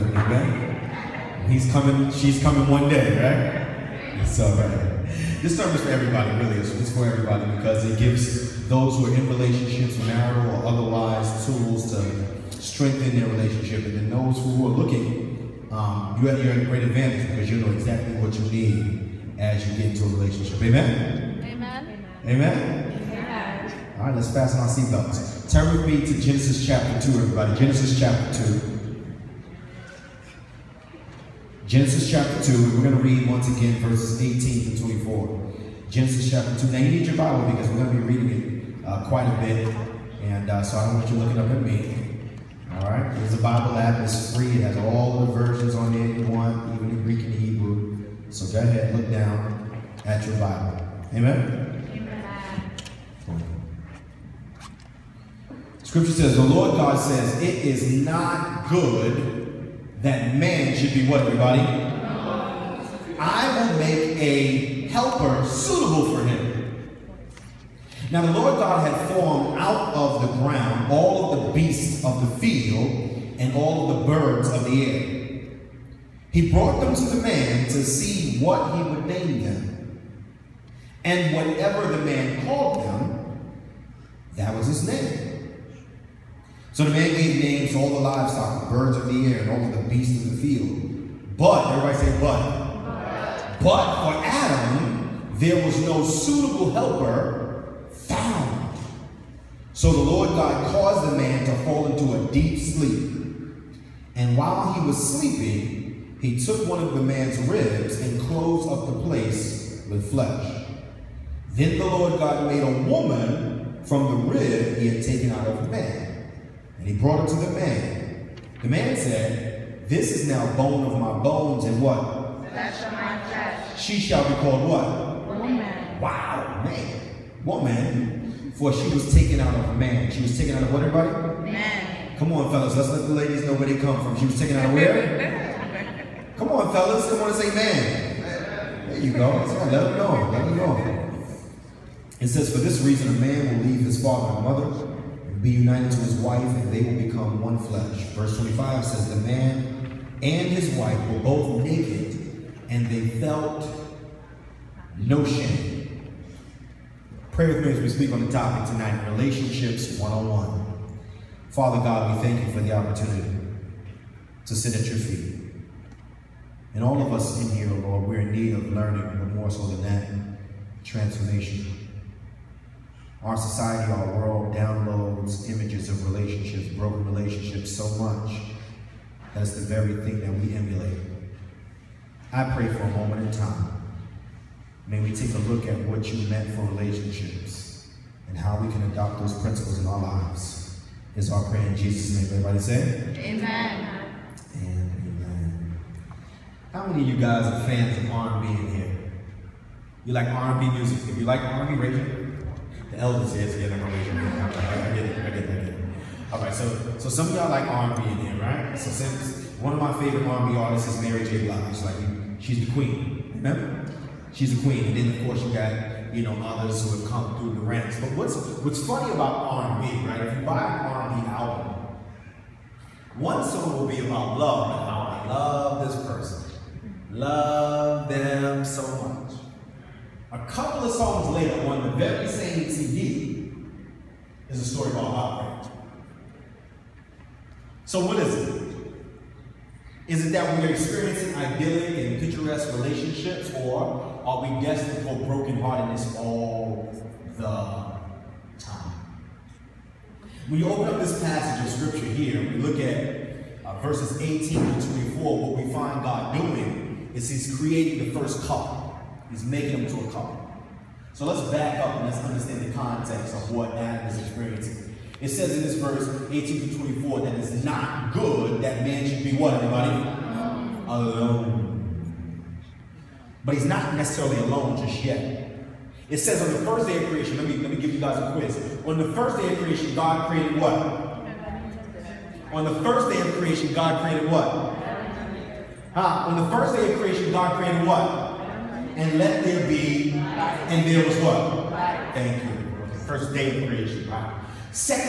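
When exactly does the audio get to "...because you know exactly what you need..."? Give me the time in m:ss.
0:17.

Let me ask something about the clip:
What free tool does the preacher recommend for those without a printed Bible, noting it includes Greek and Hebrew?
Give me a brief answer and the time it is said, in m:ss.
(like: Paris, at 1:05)
The Bible app, at 0:43.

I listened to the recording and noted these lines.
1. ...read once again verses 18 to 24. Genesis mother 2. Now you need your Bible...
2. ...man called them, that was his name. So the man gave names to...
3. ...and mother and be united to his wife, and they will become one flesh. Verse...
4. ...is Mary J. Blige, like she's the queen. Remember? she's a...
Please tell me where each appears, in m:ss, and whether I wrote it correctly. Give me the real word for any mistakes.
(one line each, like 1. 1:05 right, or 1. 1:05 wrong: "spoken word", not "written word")
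1. 0:33 wrong: "chapter", not "mother"
2. 1:22 right
3. 2:24 right
4. 3:30 right.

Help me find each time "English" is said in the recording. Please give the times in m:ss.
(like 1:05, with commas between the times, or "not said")
not said.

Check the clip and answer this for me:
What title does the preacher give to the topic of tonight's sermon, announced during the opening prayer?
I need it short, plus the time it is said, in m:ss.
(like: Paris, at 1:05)
Relationships 101, at 2:39.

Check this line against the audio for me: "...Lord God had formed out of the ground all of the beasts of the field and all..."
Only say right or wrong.
right.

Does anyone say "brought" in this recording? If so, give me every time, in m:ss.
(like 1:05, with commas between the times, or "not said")
1:16, 1:56.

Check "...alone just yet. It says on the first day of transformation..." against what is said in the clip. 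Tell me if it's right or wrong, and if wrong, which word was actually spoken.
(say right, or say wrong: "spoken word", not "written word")
wrong: "creation", not "transformation".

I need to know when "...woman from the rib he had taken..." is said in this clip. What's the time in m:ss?
1:52.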